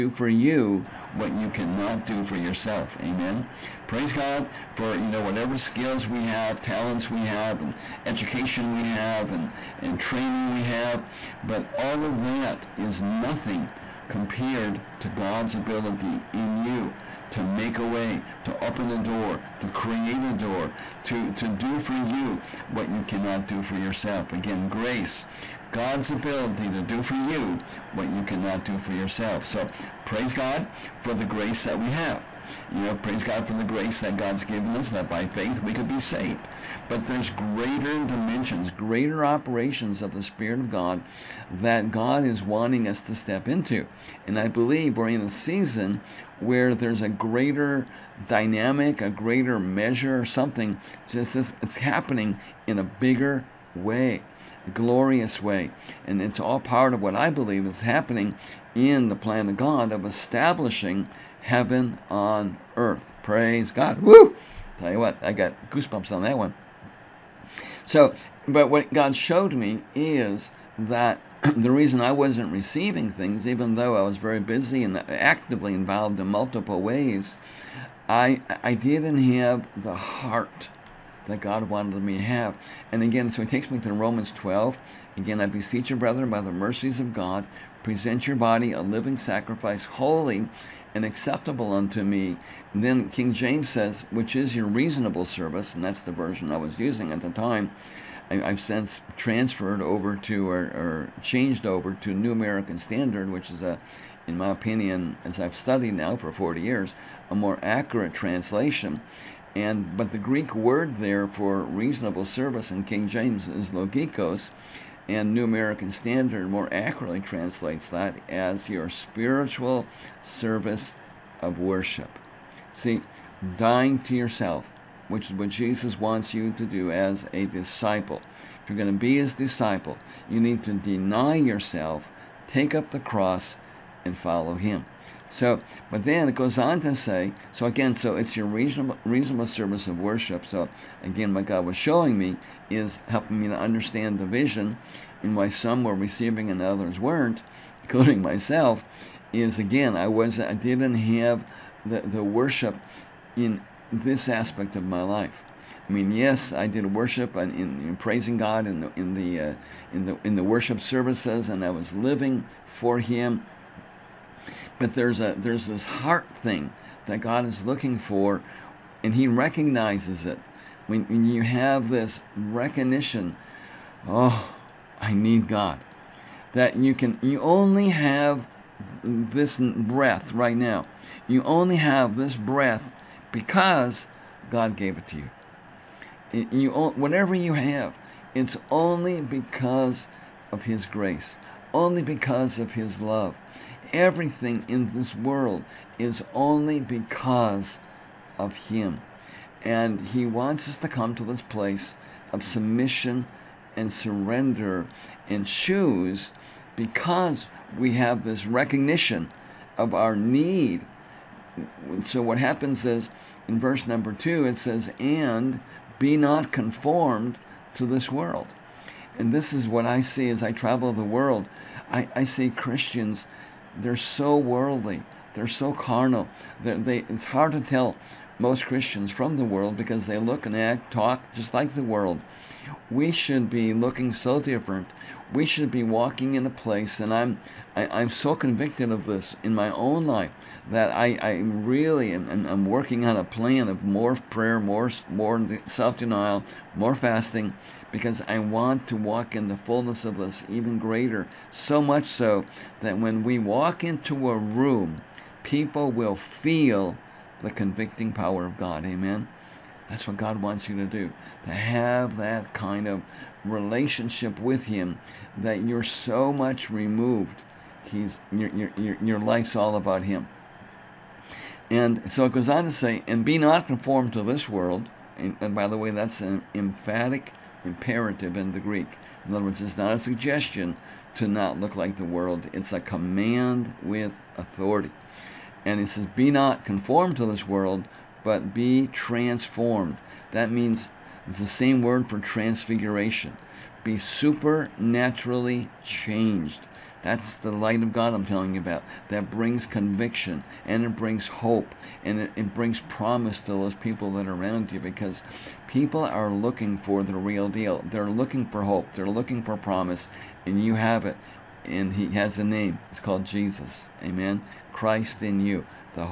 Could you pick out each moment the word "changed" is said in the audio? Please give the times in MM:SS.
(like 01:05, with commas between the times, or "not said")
01:41, 04:55.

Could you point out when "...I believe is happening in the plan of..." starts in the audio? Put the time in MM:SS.
00:57.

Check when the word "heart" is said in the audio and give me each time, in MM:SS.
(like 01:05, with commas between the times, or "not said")
01:19, 02:45.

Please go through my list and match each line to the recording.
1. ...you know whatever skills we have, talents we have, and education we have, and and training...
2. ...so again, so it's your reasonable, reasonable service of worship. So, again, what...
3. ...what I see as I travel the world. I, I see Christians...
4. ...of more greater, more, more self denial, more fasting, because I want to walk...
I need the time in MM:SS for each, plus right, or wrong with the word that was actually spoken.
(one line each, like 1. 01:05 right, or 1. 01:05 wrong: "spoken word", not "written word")
1. 00:04 right
2. 02:17 right
3. 03:39 right
4. 04:03 wrong: "prayer", not "greater".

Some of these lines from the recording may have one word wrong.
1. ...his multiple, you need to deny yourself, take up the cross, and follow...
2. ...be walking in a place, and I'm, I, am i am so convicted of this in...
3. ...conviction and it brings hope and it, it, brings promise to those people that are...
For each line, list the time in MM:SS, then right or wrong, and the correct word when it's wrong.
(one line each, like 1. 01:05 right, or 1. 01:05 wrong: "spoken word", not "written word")
1. 02:09 wrong: "disciple", not "multiple"
2. 03:55 right
3. 04:59 right.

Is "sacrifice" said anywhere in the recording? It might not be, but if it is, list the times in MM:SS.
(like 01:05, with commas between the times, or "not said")
01:29.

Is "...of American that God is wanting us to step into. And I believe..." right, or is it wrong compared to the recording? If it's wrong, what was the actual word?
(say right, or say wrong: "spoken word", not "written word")
wrong: "God", not "American".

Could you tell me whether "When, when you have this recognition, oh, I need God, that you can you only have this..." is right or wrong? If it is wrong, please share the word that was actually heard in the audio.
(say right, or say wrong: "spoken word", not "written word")
right.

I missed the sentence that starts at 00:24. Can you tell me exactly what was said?
Again, grace, God's ability to do for you what you cannot do for yourself.